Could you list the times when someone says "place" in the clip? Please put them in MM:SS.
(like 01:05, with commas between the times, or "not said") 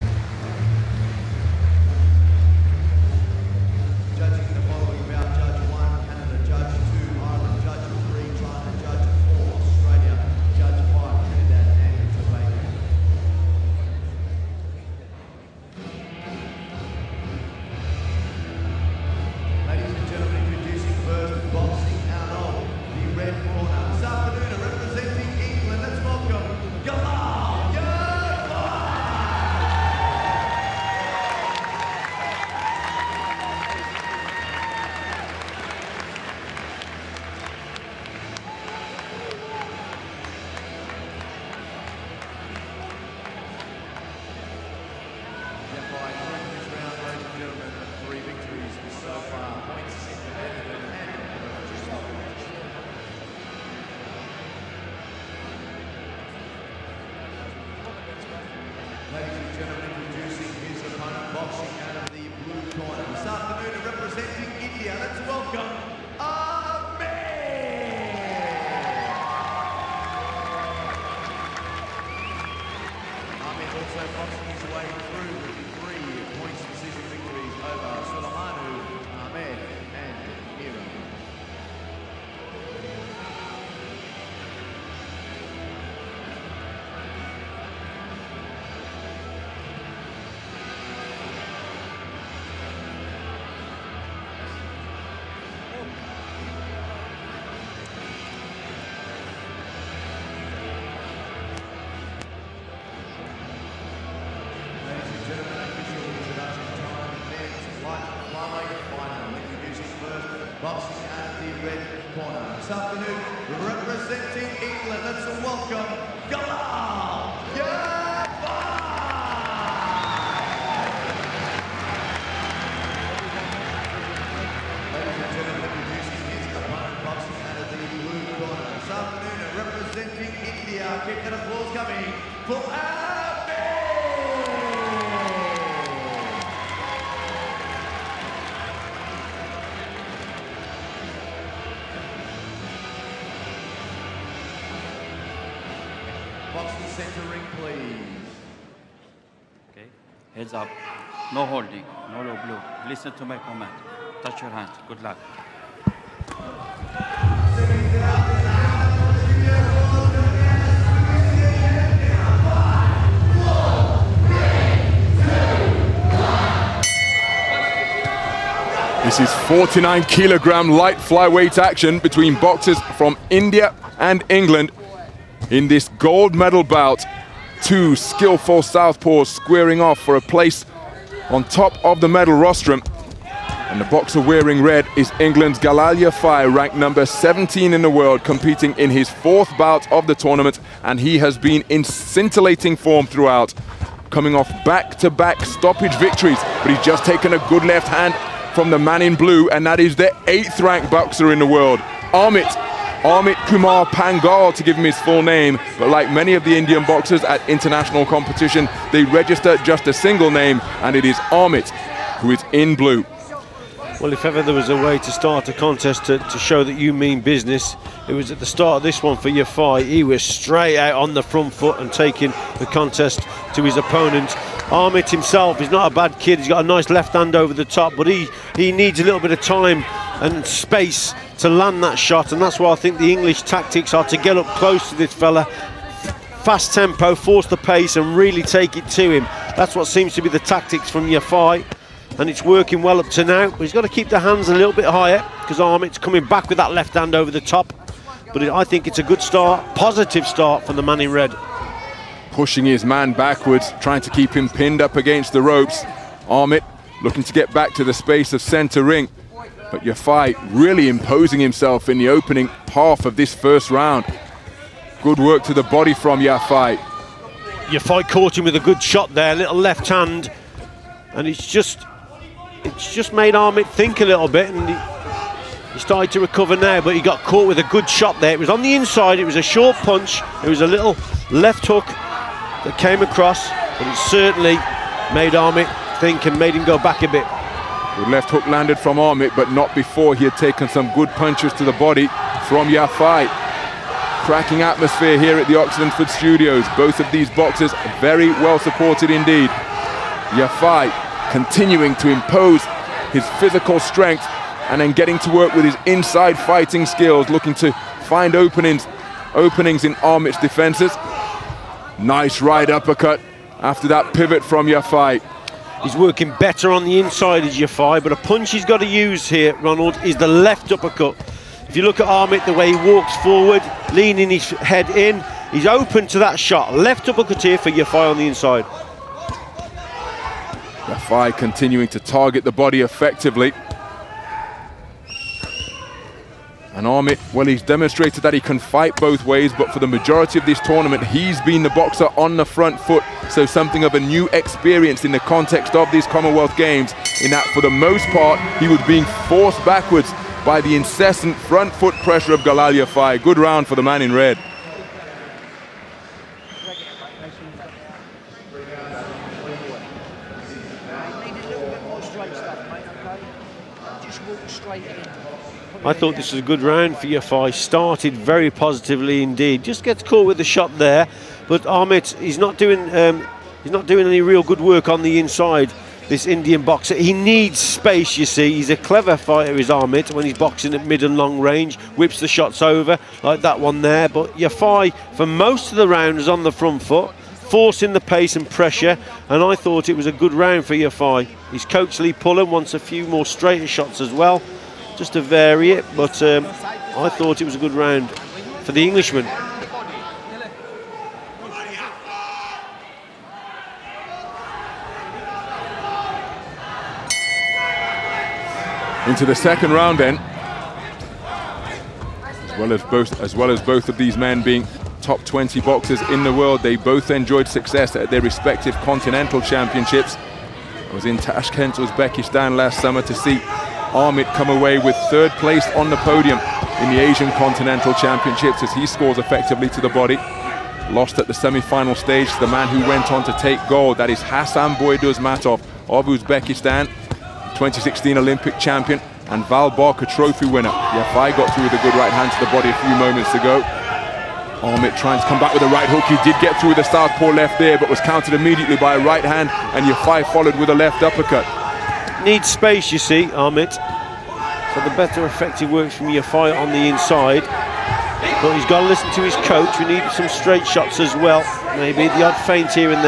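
03:00, 07:05.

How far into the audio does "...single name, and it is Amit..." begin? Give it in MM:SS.
03:29.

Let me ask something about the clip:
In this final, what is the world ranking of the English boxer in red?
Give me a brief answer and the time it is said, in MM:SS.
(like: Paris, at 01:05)
17, at 03:06.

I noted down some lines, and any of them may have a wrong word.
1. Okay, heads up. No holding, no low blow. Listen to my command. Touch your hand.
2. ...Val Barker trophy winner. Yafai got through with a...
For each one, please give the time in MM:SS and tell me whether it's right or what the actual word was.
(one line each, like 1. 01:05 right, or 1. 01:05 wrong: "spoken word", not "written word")
1. 02:29 right
2. 07:19 right.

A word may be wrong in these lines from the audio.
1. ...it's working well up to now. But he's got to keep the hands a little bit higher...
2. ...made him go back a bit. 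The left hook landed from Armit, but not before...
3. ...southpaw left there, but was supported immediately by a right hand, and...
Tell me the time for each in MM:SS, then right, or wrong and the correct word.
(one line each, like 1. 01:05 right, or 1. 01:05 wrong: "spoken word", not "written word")
1. 04:02 right
2. 04:46 right
3. 07:26 wrong: "countered", not "supported".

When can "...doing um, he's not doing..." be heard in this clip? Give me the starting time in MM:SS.
06:12.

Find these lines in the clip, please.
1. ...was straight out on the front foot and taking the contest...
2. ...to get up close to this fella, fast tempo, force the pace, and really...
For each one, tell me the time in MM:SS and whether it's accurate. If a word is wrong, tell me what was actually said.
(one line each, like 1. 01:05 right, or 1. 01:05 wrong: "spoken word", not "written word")
1. 03:40 right
2. 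03:54 right.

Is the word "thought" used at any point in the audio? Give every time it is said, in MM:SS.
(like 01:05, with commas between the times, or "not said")
06:05, 06:29, 06:37.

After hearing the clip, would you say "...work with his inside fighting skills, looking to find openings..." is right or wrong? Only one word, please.
right.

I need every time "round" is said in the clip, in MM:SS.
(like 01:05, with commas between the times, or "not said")
04:23, 05:53, 06:06, 06:25, 06:30, 06:37, 06:49.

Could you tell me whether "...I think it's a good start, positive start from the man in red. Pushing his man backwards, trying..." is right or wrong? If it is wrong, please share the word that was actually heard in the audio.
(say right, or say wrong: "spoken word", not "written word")
right.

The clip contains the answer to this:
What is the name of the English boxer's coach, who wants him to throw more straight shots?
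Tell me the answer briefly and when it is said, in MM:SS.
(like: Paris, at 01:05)
Lee Pullen, at 06:31.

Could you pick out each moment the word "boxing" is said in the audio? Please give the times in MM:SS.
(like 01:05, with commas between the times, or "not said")
01:01, 02:26, 06:20.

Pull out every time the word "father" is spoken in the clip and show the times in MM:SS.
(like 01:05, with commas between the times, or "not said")
not said.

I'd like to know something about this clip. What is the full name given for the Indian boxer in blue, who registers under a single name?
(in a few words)
Amit Kumar Panghal.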